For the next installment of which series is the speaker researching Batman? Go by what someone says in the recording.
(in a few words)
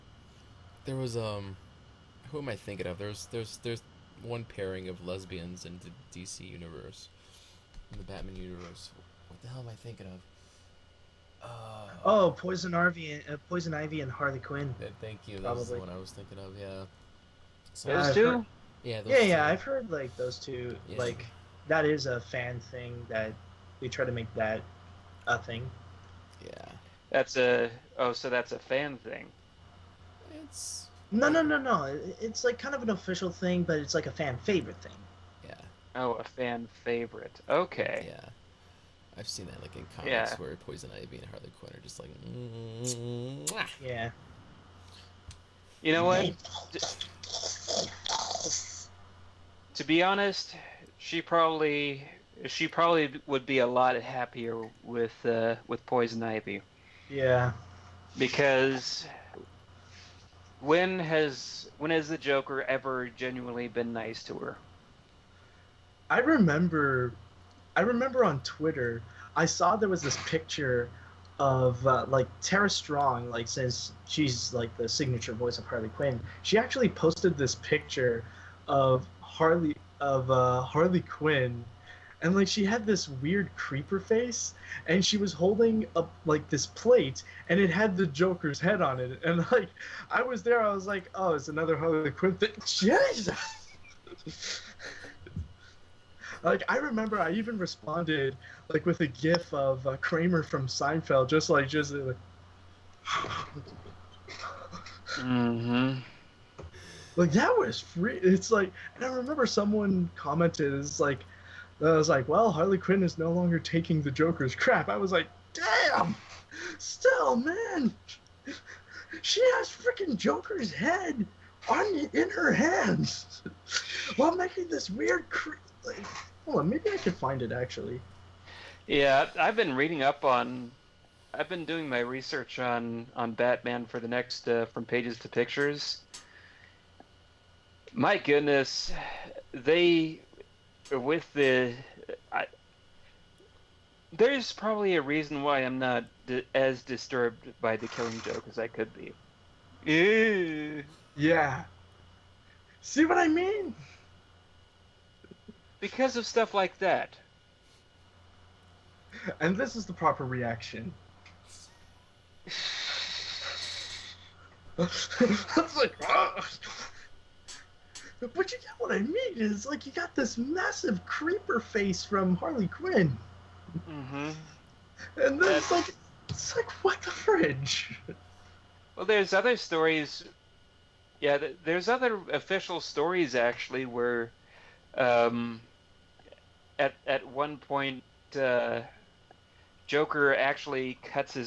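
From Pages to Pictures.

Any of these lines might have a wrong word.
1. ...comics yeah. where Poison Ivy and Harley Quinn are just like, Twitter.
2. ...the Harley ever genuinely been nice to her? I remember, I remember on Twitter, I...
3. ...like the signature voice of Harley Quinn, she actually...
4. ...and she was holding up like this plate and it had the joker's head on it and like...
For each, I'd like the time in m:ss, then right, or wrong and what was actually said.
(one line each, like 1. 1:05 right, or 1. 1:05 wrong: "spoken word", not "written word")
1. 0:39 wrong: "Mwah", not "Twitter"
2. 1:02 wrong: "Joker", not "Harley"
3. 1:14 right
4. 1:24 right.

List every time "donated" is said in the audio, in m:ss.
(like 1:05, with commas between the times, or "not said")
not said.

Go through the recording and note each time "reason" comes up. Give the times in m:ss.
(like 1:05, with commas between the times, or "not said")
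2:25.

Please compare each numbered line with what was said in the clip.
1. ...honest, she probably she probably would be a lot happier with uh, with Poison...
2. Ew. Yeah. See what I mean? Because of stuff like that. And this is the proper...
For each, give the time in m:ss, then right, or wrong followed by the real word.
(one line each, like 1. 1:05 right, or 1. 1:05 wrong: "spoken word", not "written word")
1. 0:50 right
2. 2:29 right.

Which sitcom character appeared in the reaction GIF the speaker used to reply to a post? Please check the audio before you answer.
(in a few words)
Kramer.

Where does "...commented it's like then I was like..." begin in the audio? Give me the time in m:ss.
1:50.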